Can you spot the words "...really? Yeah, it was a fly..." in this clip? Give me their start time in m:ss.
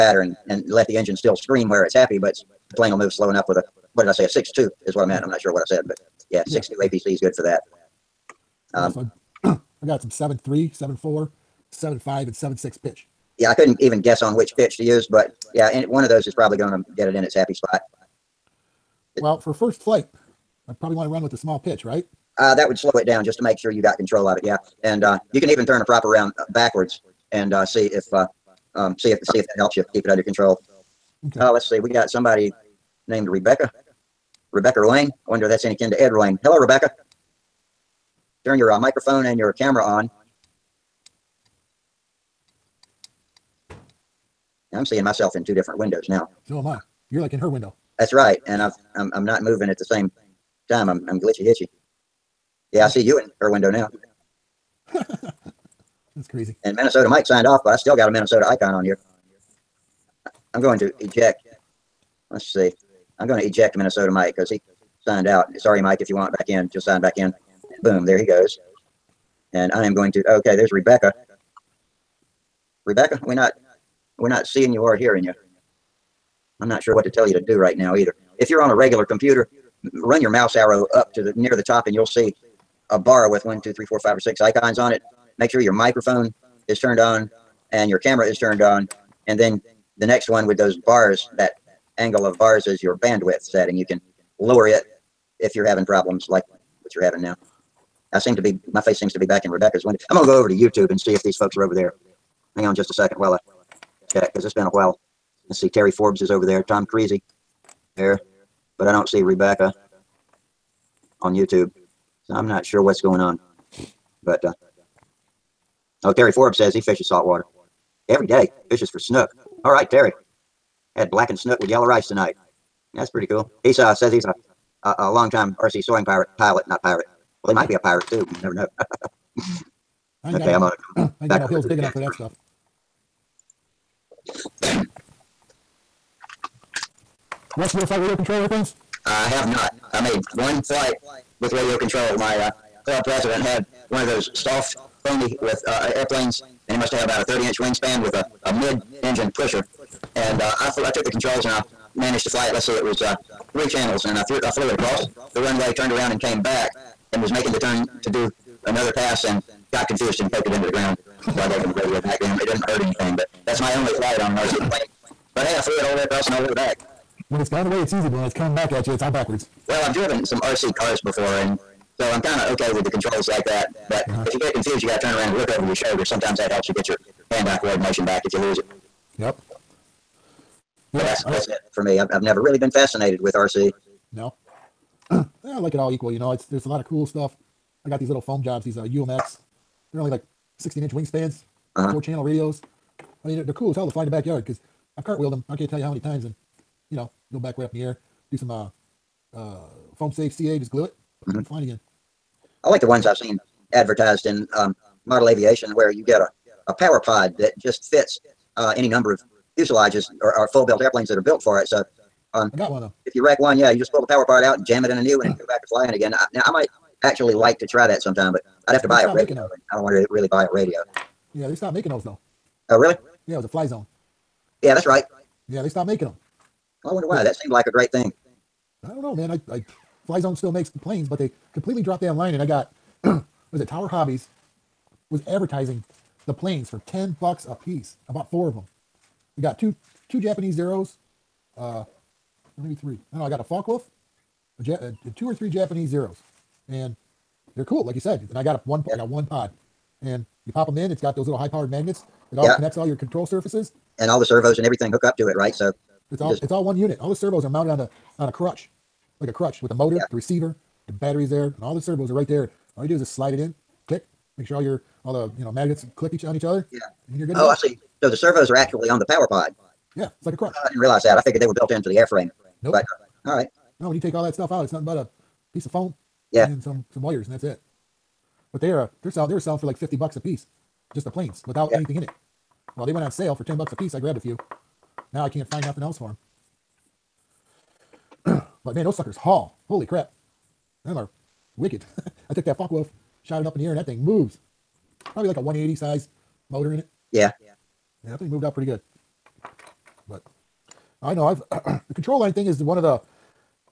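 3:42.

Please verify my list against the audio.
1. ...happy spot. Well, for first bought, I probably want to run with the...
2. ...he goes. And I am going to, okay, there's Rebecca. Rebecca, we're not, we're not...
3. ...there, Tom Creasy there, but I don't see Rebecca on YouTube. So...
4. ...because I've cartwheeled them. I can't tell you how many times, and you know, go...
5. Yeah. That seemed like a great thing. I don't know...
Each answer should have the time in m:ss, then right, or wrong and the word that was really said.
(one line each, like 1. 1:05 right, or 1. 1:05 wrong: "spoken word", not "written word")
1. 0:17 wrong: "flight", not "bought"
2. 1:08 right
3. 1:46 right
4. 3:14 right
5. 3:47 right.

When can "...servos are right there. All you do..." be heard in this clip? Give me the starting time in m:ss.
4:21.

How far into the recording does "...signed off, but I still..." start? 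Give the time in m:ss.
0:57.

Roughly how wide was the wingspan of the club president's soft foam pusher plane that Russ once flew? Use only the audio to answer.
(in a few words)
30 inches.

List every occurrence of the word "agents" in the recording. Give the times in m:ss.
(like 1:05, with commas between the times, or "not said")
not said.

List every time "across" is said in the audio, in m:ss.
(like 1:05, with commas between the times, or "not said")
2:34, 2:46.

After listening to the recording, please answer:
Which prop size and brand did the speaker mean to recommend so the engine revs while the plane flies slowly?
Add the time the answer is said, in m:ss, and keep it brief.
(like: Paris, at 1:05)
6-2 APC, at 0:06.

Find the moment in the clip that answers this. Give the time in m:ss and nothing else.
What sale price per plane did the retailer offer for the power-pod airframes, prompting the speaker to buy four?
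4:43.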